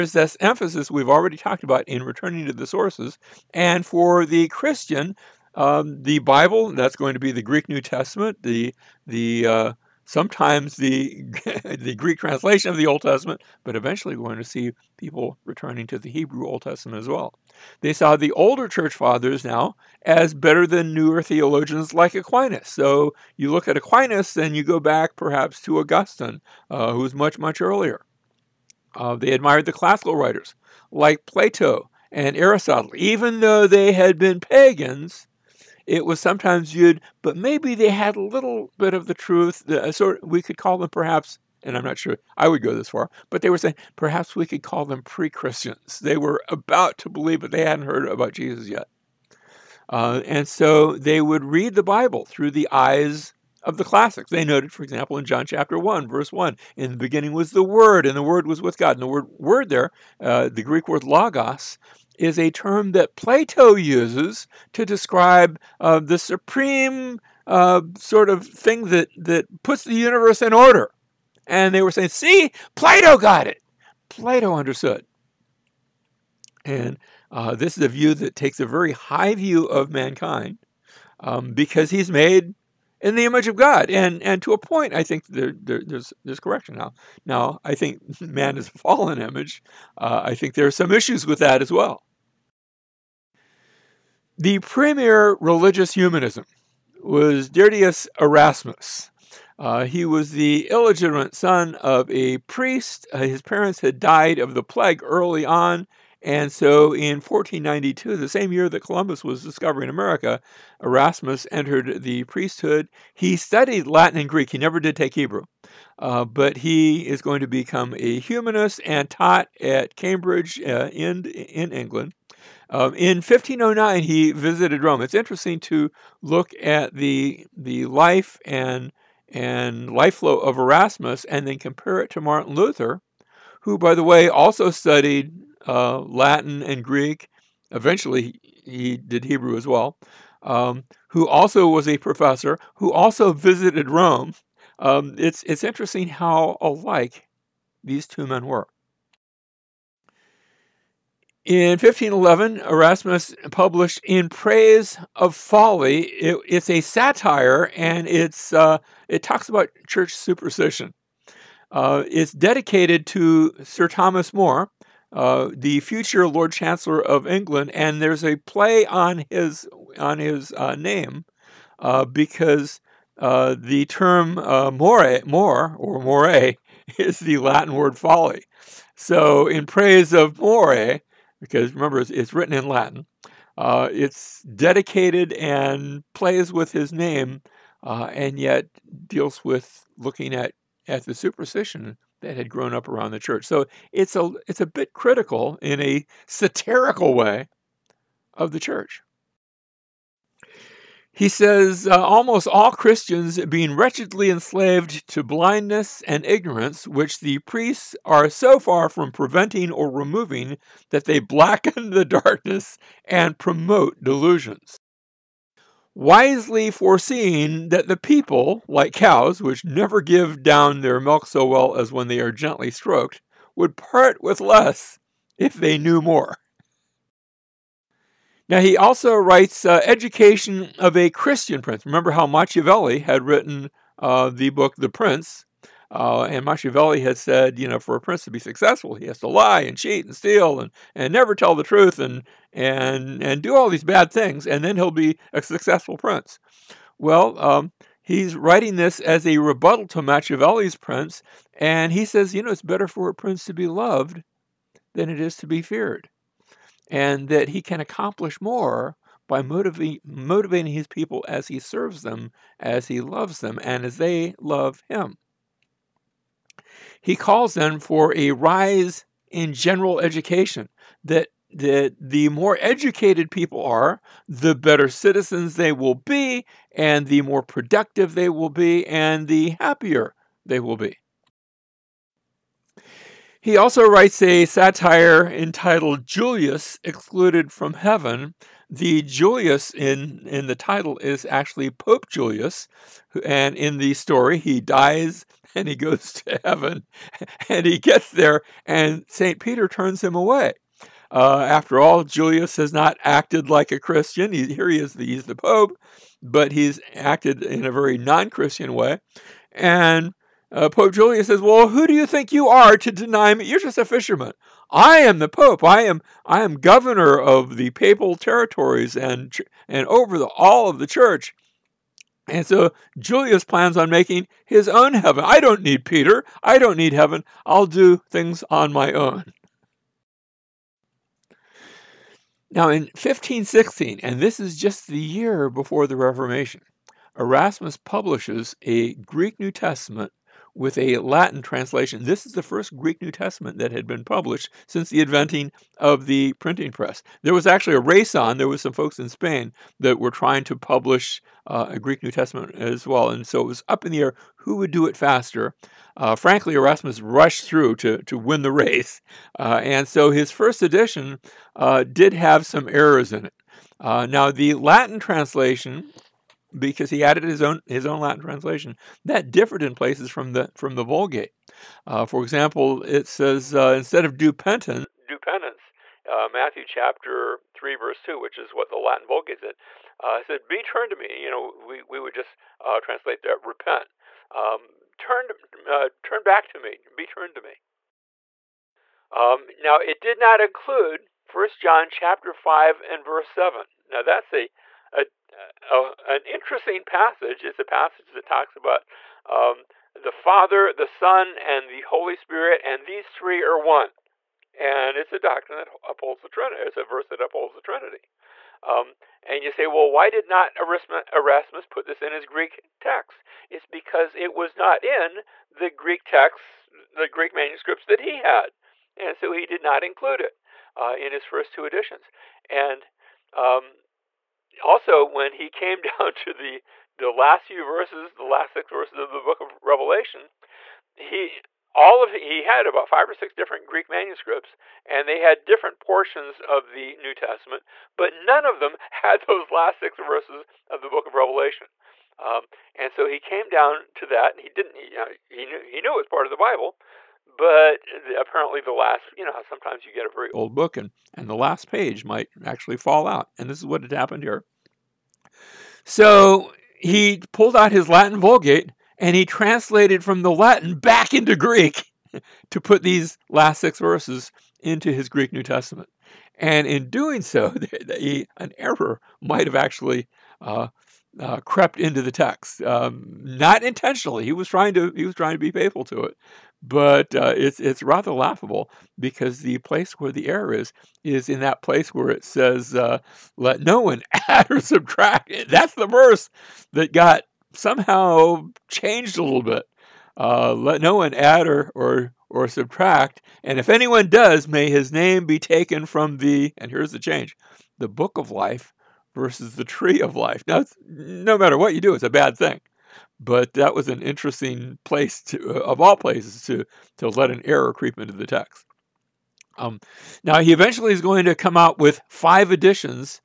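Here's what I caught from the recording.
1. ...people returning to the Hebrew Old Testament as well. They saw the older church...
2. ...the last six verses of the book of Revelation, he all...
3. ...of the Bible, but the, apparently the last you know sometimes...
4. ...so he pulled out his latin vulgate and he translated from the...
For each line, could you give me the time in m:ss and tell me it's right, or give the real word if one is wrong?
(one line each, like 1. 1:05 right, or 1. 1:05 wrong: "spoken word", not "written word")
1. 0:14 right
2. 7:08 right
3. 7:26 right
4. 7:35 right.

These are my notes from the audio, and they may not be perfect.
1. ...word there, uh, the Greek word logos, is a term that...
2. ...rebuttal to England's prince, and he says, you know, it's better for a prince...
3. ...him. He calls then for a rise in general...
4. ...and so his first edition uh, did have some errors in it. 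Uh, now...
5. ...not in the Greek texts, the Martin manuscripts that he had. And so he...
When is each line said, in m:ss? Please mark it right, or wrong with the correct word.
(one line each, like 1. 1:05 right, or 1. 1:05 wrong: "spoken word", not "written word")
1. 0:59 right
2. 4:09 wrong: "Machiavelli", not "England"
3. 4:24 right
4. 5:59 right
5. 6:54 wrong: "Greek", not "Martin".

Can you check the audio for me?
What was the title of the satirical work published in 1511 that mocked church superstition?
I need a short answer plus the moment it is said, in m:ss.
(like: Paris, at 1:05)
In Praise of Folly, at 2:34.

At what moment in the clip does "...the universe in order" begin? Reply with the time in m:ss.
1:09.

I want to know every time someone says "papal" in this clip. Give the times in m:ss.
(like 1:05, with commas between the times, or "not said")
5:17.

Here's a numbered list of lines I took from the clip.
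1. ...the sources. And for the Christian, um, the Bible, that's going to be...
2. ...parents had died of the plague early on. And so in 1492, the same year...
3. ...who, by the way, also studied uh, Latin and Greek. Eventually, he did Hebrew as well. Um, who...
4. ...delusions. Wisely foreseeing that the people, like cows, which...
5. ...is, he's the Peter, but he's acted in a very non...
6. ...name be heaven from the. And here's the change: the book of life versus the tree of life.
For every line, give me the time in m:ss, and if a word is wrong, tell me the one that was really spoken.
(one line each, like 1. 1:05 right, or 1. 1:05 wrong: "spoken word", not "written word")
1. 0:02 right
2. 1:43 right
3. 2:13 right
4. 3:34 right
5. 5:04 wrong: "Pope", not "Peter"
6. 8:14 wrong: "taken", not "heaven".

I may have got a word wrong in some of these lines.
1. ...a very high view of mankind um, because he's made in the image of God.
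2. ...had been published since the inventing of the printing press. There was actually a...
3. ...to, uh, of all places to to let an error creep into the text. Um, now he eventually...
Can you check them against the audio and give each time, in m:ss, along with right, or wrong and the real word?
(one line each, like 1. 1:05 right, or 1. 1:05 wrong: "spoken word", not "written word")
1. 1:18 right
2. 5:43 right
3. 8:25 right.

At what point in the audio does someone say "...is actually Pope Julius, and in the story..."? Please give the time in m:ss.
4:50.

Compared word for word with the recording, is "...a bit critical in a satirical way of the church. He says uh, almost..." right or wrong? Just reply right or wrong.
right.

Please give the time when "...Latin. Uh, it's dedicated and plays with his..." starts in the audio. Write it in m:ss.
3:02.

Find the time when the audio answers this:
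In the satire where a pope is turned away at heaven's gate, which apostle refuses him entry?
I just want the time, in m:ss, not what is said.
4:59.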